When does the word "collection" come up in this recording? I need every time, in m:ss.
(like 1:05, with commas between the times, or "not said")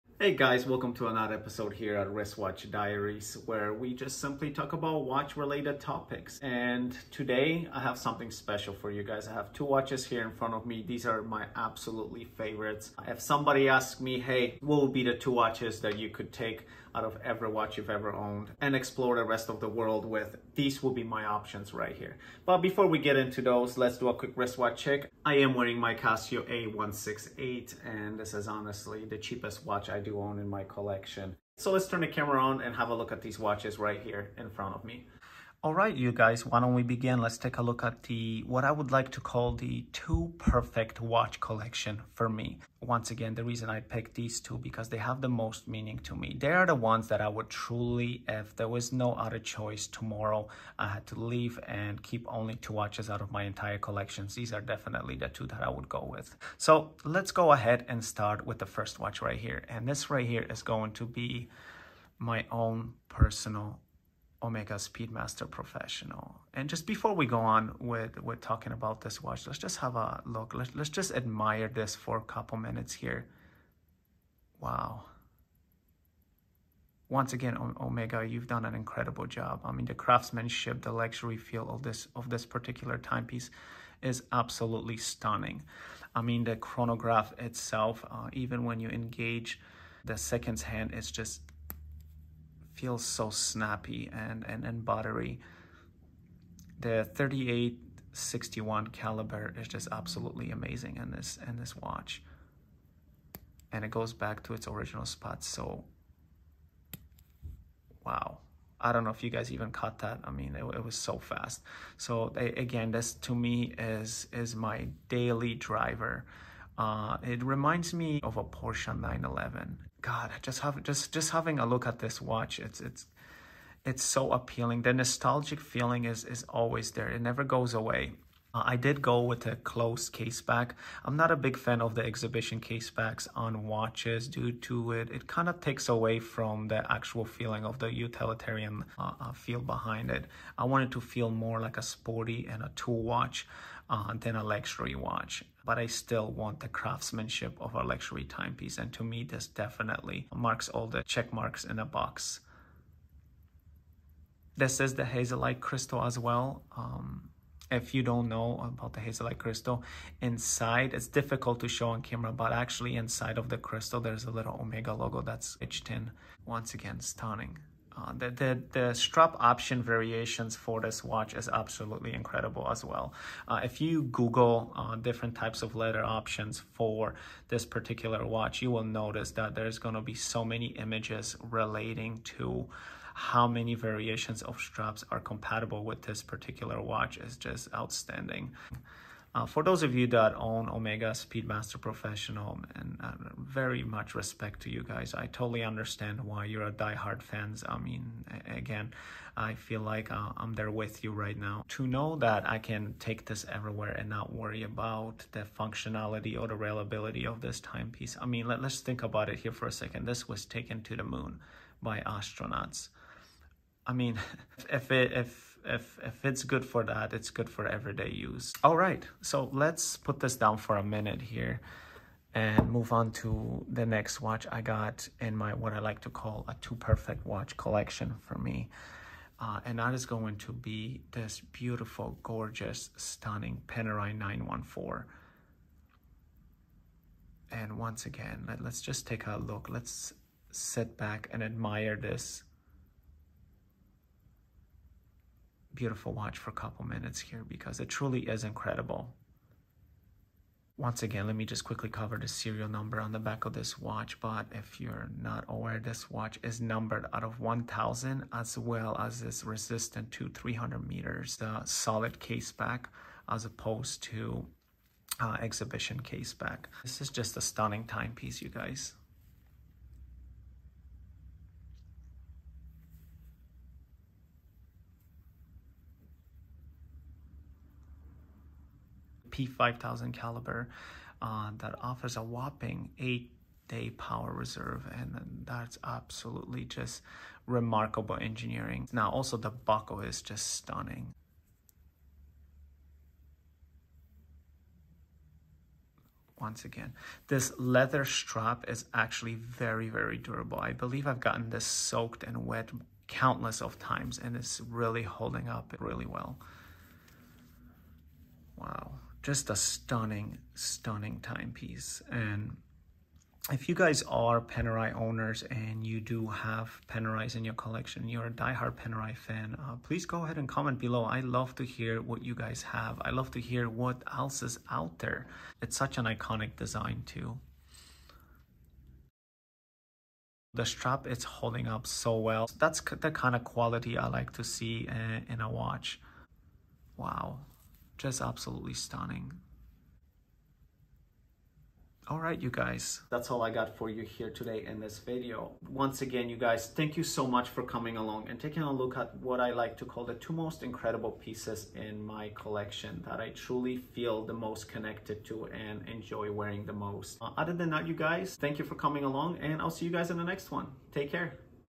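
0:30, 0:41, 0:53, 3:47, 5:17, 5:52.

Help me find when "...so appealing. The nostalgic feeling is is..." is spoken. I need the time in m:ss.
2:04.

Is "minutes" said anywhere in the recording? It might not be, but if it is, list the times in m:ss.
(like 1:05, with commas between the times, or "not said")
1:12, 3:40, 4:06.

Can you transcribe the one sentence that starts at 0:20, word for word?
These will be my options right here.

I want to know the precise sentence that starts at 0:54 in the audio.
These are definitely the two that I would go with.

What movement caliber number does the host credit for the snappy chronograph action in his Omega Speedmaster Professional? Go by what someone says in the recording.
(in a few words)
3861.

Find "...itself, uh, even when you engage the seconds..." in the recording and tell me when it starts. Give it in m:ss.
1:27.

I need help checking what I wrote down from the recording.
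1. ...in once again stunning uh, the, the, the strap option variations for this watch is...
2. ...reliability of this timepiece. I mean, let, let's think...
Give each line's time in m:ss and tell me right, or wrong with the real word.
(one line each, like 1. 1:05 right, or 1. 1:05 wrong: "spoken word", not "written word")
1. 2:45 right
2. 3:26 right.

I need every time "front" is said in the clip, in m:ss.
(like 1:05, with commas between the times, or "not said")
0:10, 0:34.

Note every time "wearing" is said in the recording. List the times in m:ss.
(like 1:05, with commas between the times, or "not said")
0:25, 5:56.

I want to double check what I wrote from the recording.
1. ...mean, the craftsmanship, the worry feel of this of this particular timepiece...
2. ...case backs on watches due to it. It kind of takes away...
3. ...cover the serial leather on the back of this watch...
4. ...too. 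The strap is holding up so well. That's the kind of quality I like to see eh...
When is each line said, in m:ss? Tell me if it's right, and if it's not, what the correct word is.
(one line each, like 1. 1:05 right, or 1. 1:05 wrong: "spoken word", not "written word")
1. 1:19 wrong: "luxury", not "worry"
2. 2:12 right
3. 4:11 wrong: "number", not "leather"
4. 5:27 right.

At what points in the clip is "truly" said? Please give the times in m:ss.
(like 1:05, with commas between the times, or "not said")
0:47, 4:07, 5:53.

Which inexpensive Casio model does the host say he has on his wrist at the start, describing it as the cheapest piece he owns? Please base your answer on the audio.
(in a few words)
Casio A168.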